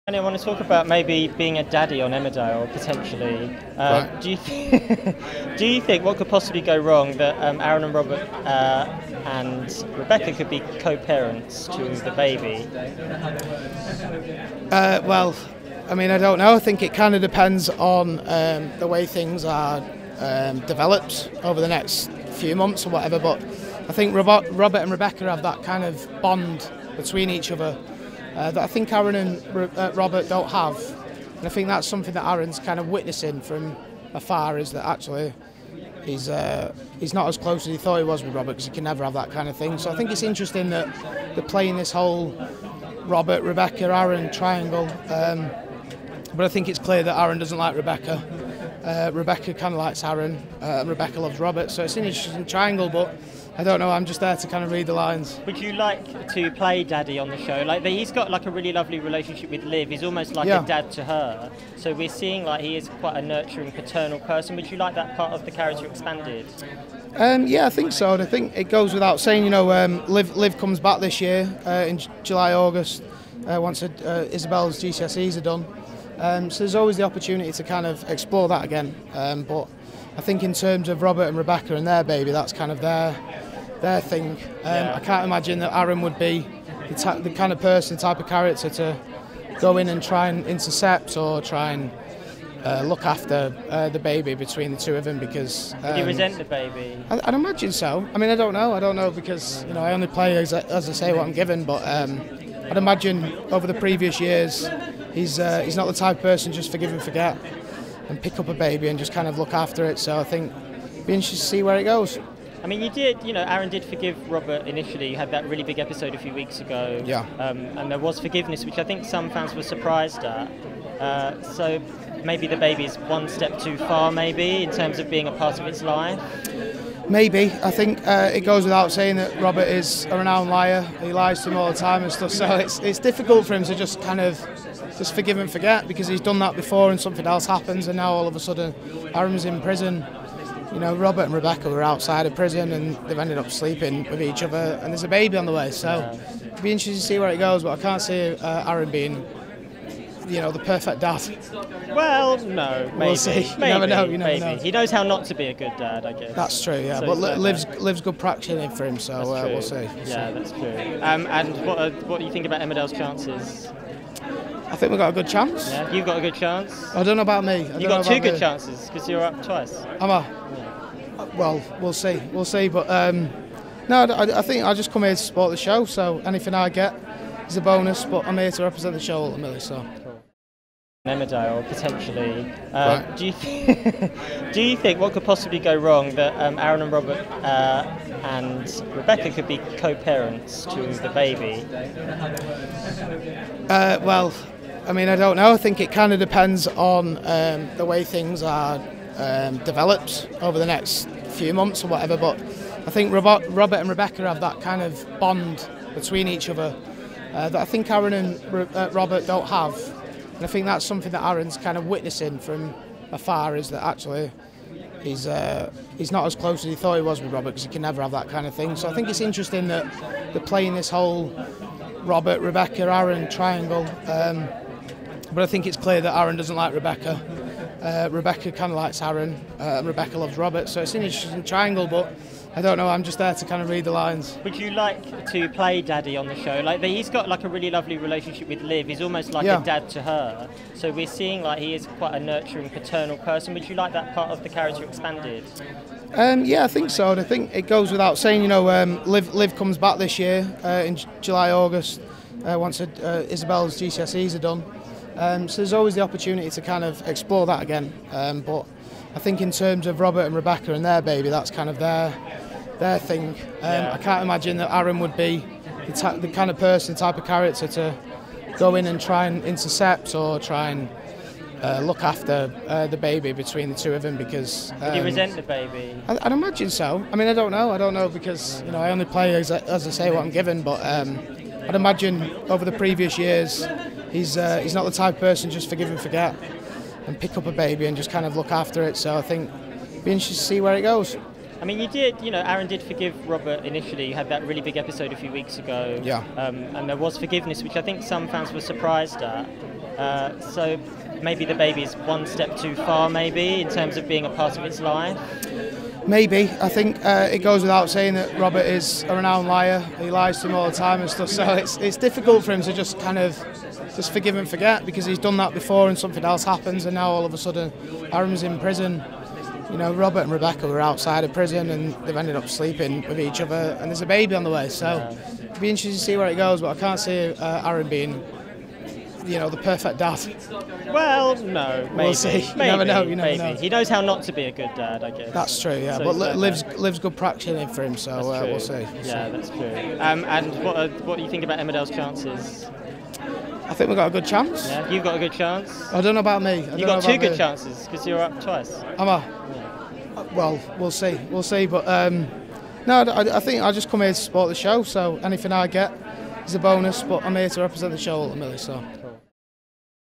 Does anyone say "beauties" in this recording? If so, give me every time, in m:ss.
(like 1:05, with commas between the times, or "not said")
not said.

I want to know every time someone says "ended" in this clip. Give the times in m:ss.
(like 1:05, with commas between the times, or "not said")
2:23, 5:22.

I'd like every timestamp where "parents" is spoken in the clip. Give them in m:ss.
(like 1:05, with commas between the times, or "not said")
0:10, 3:09.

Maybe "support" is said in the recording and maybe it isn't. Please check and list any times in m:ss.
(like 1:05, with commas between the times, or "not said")
2:55, 5:54.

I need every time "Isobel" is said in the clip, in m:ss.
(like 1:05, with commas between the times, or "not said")
1:14, 4:13.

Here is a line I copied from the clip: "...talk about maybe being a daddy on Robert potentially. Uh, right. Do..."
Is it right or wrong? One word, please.
wrong.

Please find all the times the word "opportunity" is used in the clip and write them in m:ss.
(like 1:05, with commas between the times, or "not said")
1:17, 4:16.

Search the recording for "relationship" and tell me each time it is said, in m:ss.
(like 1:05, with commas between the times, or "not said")
0:59, 3:57.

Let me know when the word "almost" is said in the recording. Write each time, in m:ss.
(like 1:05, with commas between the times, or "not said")
1:00, 3:58.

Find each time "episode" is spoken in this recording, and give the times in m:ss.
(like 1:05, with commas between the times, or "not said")
1:55, 4:54.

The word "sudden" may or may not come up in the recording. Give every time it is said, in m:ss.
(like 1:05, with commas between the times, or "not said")
2:18, 5:17.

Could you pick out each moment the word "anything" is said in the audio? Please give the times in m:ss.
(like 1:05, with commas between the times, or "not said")
2:56, 5:55.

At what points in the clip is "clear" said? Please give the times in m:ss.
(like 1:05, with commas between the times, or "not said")
0:46, 3:45.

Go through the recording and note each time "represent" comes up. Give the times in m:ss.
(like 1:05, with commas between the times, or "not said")
2:58, 5:57.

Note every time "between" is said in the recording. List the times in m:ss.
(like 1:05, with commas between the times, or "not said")
0:26, 1:34, 3:25, 4:33.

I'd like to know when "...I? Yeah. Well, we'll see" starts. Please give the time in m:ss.
2:50.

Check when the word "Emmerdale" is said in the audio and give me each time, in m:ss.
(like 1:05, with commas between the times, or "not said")
0:02, 2:42, 3:01, 5:41.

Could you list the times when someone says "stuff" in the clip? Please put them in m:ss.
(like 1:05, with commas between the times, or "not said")
2:12, 5:11.